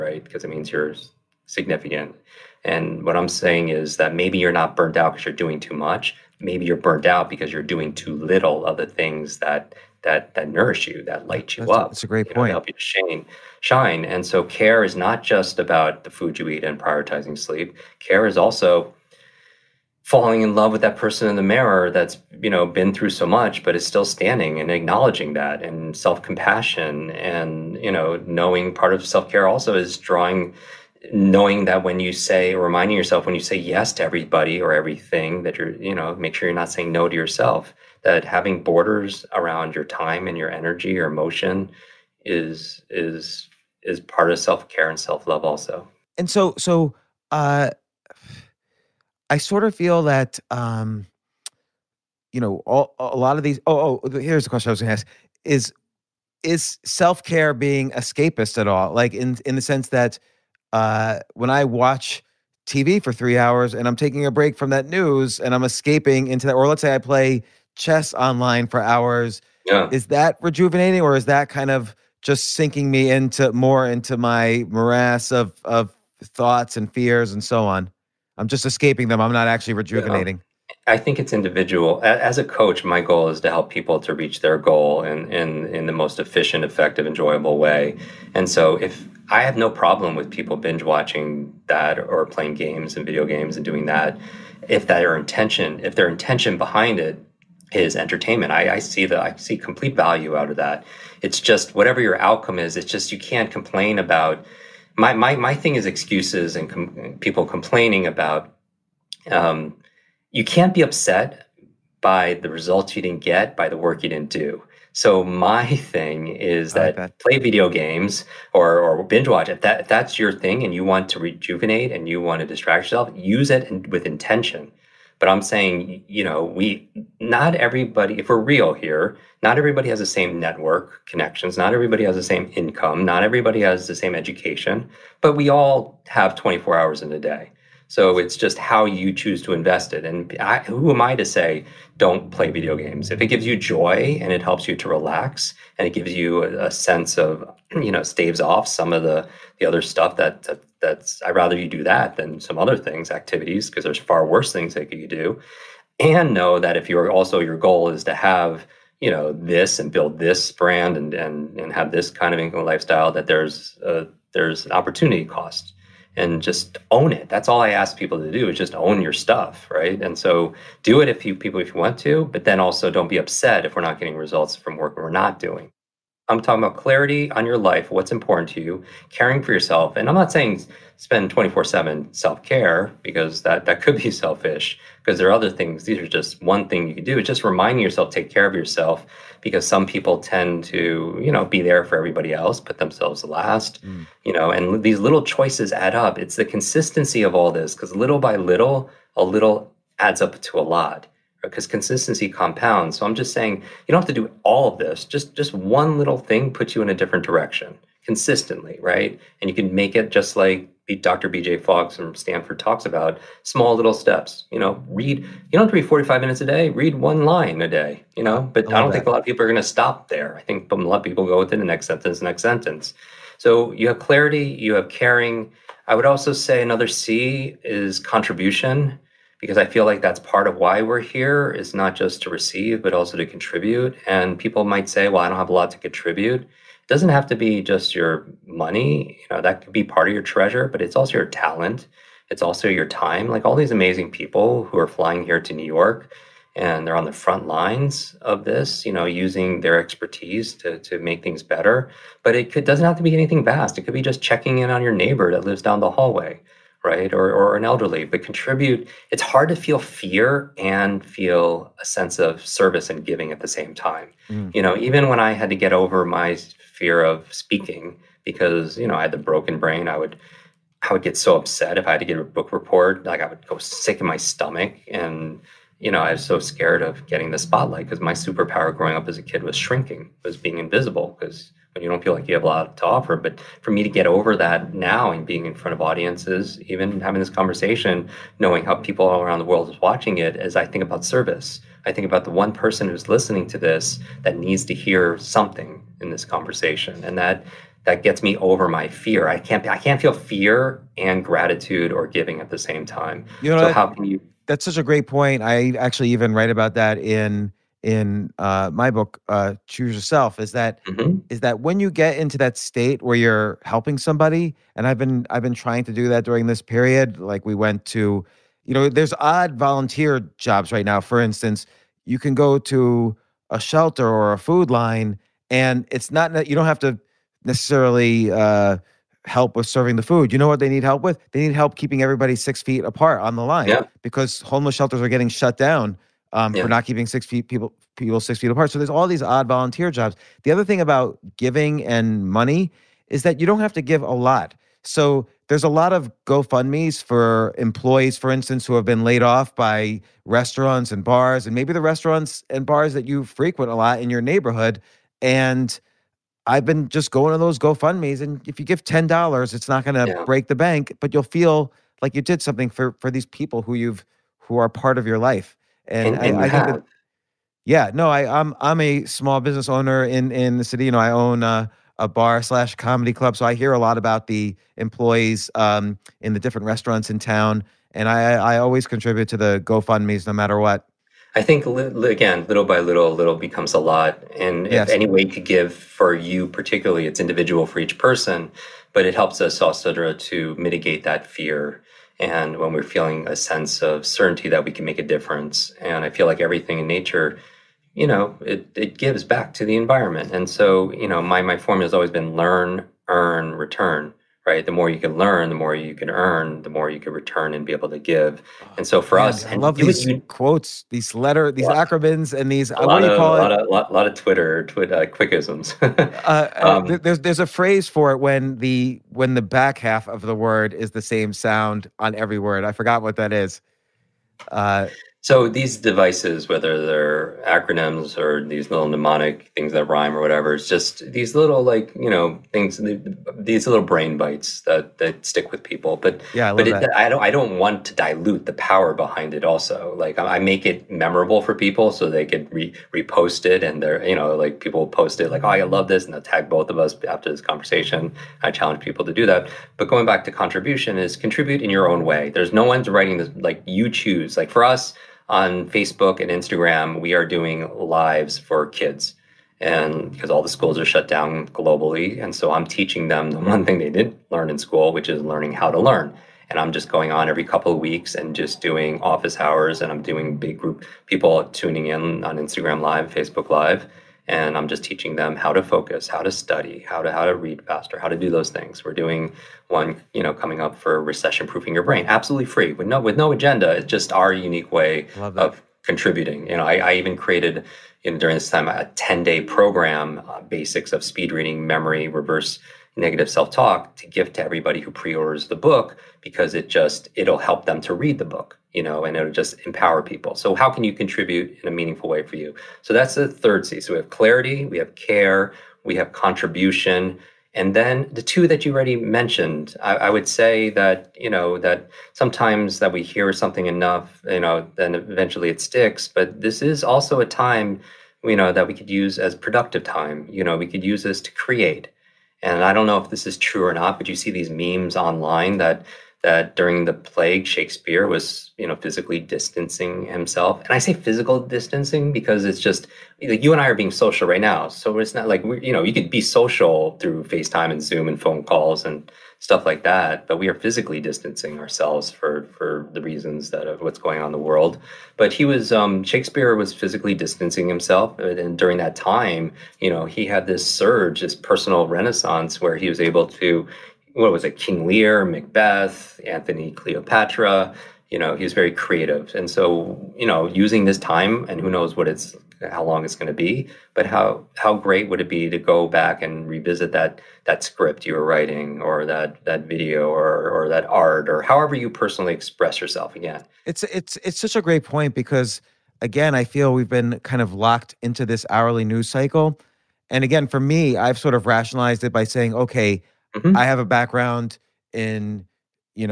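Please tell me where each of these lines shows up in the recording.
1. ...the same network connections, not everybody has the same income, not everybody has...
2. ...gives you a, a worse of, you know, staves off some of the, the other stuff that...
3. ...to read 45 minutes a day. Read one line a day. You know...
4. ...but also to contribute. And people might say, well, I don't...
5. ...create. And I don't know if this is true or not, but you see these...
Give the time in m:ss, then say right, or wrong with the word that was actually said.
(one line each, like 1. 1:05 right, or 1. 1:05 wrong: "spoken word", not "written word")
1. 2:09 right
2. 2:25 wrong: "sense", not "worse"
3. 3:35 right
4. 3:52 right
5. 8:41 right.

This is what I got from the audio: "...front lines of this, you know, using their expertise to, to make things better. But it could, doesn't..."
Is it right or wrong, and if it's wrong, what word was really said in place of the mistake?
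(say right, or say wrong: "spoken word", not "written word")
right.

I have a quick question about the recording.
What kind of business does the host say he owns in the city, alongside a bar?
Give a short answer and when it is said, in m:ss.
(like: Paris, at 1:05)
comedy club, at 6:12.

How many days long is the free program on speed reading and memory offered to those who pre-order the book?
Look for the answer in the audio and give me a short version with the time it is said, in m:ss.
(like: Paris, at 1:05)
10, at 8:08.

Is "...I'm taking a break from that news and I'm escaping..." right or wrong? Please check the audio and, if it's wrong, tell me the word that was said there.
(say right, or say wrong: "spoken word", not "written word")
right.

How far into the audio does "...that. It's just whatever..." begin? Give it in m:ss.
1:40.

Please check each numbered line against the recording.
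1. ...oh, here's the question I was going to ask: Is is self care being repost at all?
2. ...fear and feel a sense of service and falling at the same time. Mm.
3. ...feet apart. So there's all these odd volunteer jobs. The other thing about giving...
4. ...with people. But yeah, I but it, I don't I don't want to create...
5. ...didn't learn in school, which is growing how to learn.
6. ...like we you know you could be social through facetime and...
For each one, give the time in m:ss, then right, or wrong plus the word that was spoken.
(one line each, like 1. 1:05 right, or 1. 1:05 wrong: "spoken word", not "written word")
1. 0:54 wrong: "escapist", not "repost"
2. 4:19 wrong: "giving", not "falling"
3. 5:38 right
4. 7:15 wrong: "dilute", not "create"
5. 7:43 wrong: "learning", not "growing"
6. 8:55 right.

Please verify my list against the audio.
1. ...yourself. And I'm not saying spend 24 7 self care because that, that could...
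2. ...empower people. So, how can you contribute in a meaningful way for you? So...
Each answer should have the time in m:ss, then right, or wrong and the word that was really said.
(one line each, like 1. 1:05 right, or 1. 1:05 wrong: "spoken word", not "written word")
1. 2:59 right
2. 8:19 right.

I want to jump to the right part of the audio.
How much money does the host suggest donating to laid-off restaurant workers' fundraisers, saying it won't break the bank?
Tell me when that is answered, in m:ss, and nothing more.
5:58.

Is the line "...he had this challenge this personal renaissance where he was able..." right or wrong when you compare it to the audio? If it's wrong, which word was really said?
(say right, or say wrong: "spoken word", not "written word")
wrong: "surge", not "challenge".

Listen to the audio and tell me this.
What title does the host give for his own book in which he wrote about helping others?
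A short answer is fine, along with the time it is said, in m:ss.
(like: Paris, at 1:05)
Choose Yourself, at 5:09.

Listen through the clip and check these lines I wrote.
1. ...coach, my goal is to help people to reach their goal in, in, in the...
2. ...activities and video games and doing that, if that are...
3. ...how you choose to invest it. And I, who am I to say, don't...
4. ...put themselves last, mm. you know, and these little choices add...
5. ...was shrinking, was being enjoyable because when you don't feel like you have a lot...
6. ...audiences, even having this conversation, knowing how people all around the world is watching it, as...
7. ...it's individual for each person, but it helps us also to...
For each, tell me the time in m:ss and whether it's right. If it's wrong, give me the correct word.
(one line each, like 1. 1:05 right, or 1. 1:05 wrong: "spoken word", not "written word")
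1. 1:22 right
2. 1:32 wrong: "games", not "activities"
3. 2:18 right
4. 3:12 right
5. 4:39 wrong: "invisible", not "enjoyable"
6. 4:45 right
7. 6:27 right.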